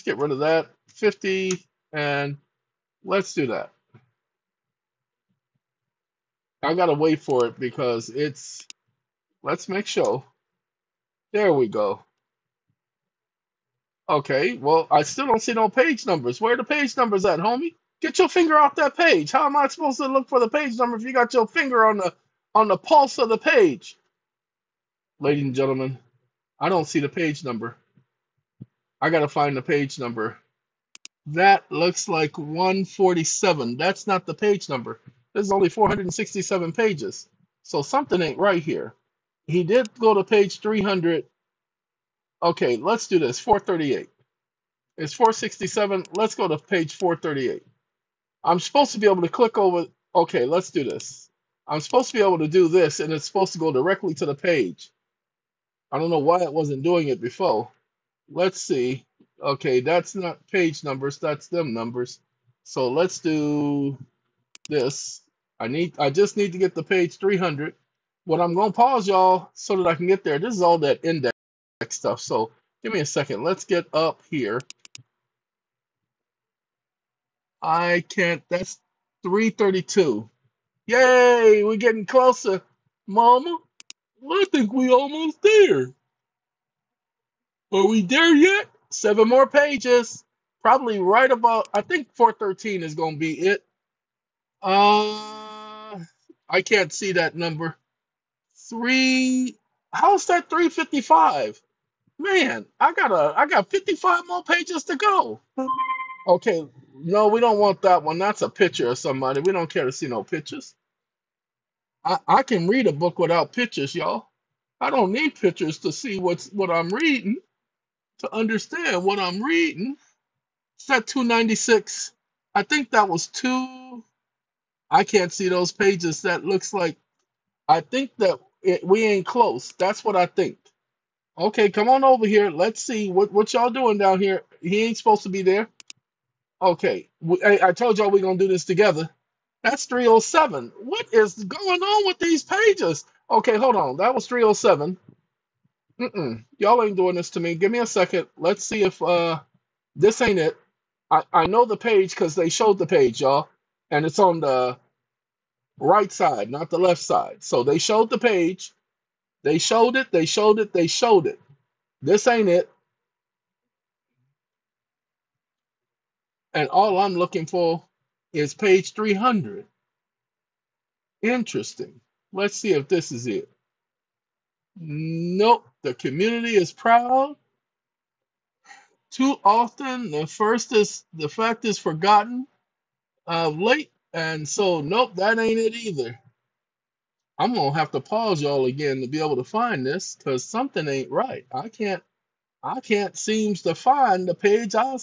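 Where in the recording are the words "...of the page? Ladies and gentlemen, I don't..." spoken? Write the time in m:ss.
0:23.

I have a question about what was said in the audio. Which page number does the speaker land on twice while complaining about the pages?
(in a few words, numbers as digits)
307.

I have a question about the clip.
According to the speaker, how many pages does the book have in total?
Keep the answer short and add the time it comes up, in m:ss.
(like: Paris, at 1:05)
467, at 0:35.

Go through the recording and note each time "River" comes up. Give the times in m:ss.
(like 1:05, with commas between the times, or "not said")
not said.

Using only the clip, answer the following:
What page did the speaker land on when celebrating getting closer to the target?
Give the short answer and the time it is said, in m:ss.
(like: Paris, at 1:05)
332, at 1:18.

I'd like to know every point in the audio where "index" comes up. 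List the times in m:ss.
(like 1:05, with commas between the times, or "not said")
1:11.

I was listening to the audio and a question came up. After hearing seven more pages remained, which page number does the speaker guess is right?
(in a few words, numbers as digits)
413.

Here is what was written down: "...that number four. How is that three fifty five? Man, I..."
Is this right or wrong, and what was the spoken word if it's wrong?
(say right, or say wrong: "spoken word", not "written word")
wrong: "three", not "four".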